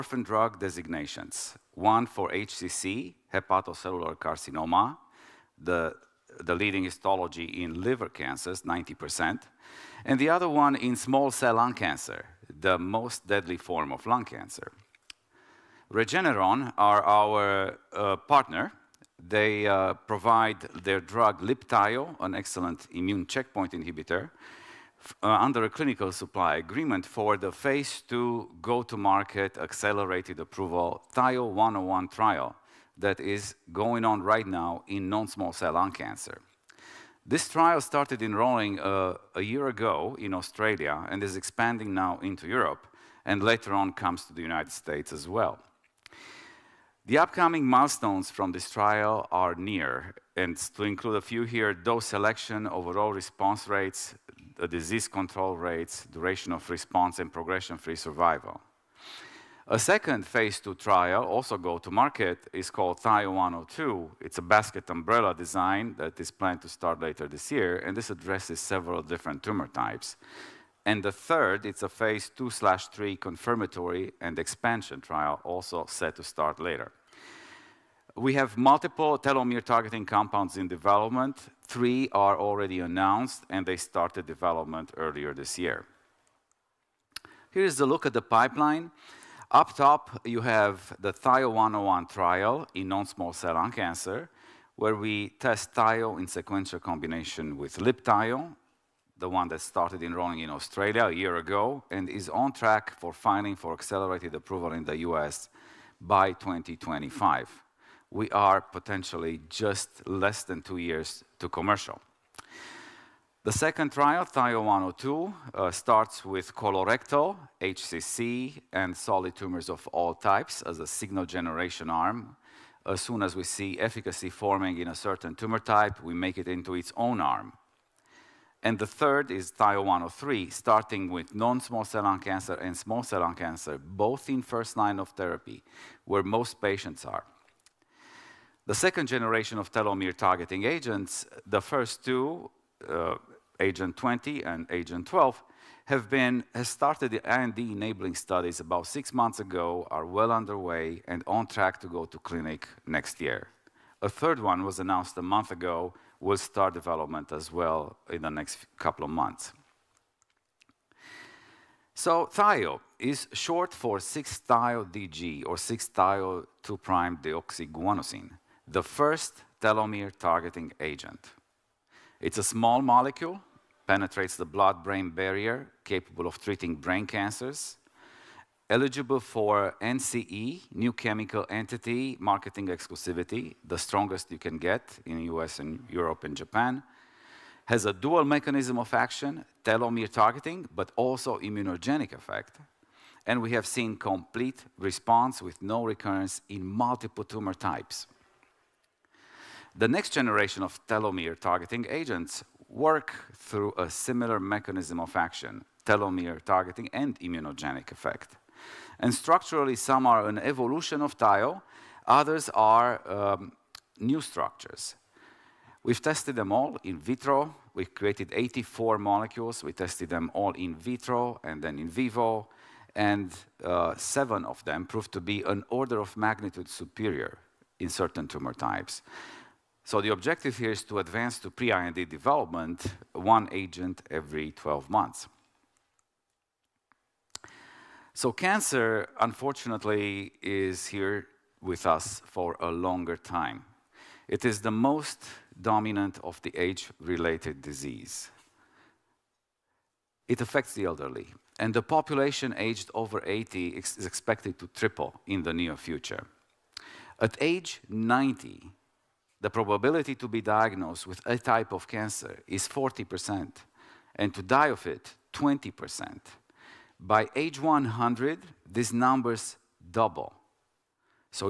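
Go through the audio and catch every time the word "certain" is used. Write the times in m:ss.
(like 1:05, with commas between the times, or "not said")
2:04, 3:47.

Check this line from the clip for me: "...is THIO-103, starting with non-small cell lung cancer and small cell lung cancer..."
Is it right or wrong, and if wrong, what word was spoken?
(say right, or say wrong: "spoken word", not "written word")
right.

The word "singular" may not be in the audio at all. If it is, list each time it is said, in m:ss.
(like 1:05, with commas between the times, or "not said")
not said.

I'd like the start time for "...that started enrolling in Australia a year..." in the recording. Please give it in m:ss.
1:39.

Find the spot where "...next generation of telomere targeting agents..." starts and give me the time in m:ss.
3:19.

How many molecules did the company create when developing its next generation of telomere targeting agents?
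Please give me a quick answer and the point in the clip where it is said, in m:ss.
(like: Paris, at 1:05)
84, at 3:38.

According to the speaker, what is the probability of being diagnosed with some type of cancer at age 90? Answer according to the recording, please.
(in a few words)
40%.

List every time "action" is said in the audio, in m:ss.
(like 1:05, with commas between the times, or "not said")
3:08, 3:25.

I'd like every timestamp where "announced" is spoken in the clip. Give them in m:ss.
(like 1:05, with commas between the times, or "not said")
1:22, 2:34.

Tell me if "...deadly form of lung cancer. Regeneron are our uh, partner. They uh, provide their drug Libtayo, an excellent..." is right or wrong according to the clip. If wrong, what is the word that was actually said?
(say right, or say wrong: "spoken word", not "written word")
right.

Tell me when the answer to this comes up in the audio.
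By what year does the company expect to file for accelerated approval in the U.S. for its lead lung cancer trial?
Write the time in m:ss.
1:46.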